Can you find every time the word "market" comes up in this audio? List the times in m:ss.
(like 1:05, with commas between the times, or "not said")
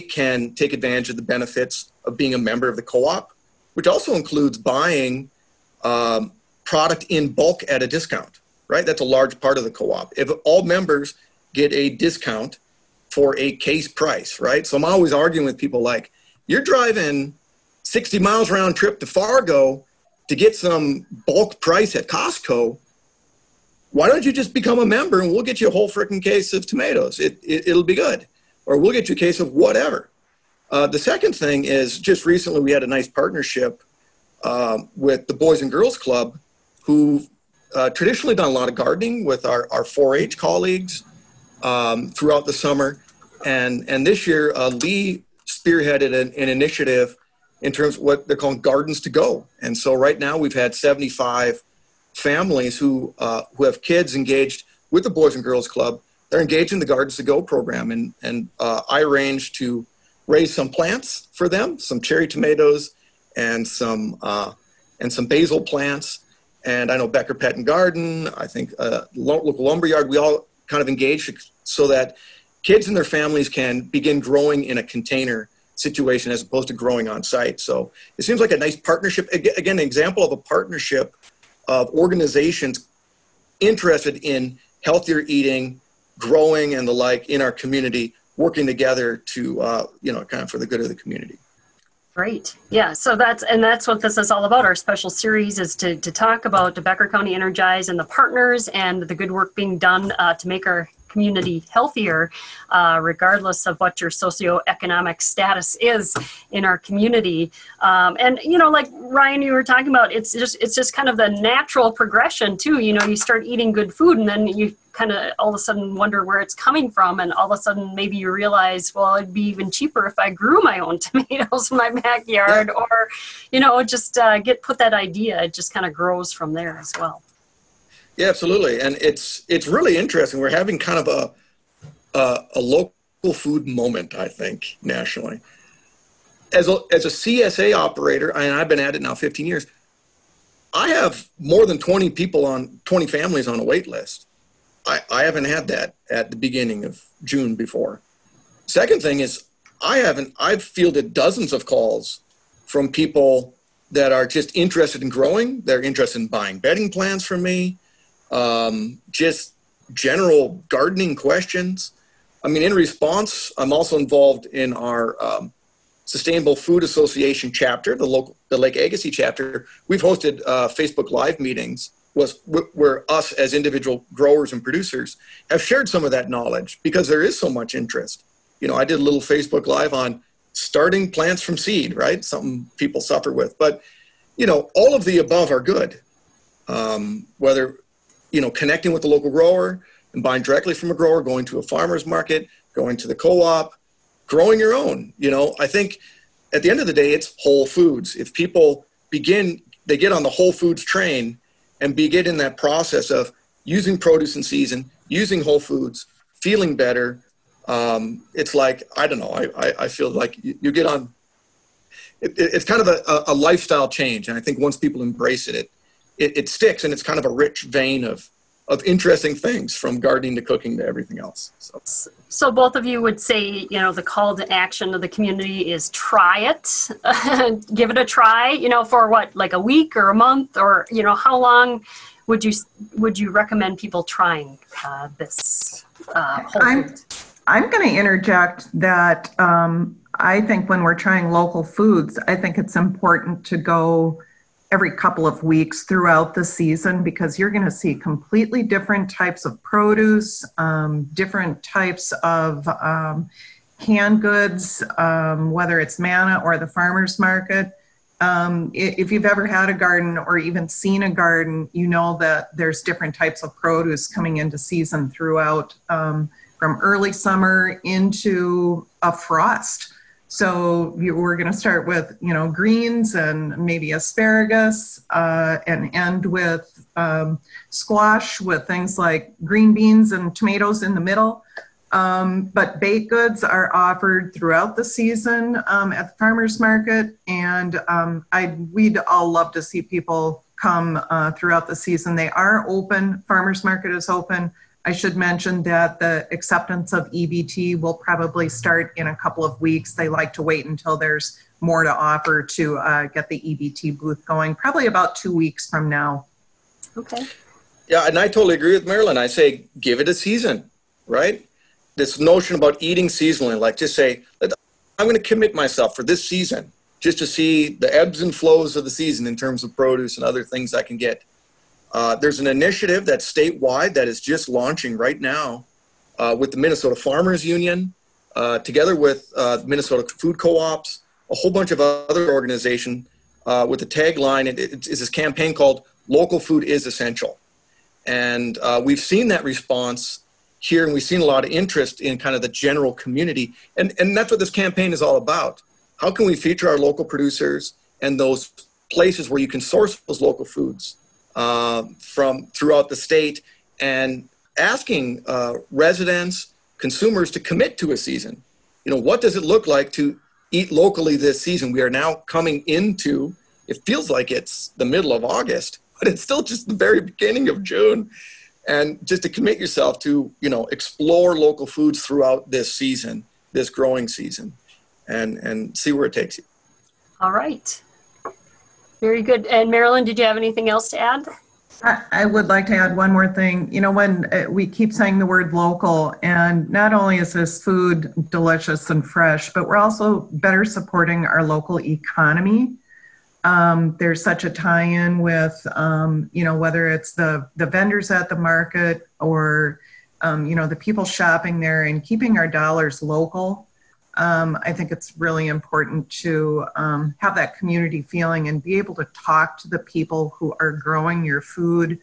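3:12, 4:17, 4:46, 4:53, 6:38.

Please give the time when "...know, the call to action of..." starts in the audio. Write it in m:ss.
3:43.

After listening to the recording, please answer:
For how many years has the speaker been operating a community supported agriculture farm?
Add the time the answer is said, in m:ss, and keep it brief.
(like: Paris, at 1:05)
15 years, at 2:19.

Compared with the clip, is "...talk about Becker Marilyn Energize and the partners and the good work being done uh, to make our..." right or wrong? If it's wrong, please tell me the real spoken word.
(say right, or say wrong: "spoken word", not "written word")
wrong: "County", not "Marilyn".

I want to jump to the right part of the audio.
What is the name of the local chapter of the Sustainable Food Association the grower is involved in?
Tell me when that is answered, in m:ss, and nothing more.
2:48.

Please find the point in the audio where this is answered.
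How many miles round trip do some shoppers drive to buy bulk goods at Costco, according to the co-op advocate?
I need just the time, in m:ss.
0:17.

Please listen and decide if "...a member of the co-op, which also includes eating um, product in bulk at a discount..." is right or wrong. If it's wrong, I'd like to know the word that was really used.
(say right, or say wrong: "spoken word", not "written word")
wrong: "buying", not "eating".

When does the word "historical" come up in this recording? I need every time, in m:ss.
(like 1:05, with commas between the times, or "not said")
not said.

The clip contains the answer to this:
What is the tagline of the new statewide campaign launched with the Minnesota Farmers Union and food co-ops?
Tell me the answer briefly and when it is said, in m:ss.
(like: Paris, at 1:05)
Local Food is Essential, at 5:36.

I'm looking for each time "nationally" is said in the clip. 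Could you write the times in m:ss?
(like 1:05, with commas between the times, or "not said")
2:14.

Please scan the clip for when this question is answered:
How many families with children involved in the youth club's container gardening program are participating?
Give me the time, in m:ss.
0:50.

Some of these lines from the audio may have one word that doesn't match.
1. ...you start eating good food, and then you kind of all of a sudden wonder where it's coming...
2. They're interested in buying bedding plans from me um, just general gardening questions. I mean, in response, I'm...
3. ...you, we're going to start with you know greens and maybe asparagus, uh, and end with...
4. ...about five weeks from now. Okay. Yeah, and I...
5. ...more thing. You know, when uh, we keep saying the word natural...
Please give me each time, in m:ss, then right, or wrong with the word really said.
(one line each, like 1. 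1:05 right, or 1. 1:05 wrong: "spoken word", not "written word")
1. 1:53 right
2. 2:35 right
3. 4:30 right
4. 5:04 wrong: "two", not "five"
5. 6:23 wrong: "local", not "natural".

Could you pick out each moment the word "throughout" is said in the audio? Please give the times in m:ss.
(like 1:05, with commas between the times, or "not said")
0:42, 4:05, 4:25, 4:44, 4:51, 5:52, 6:12.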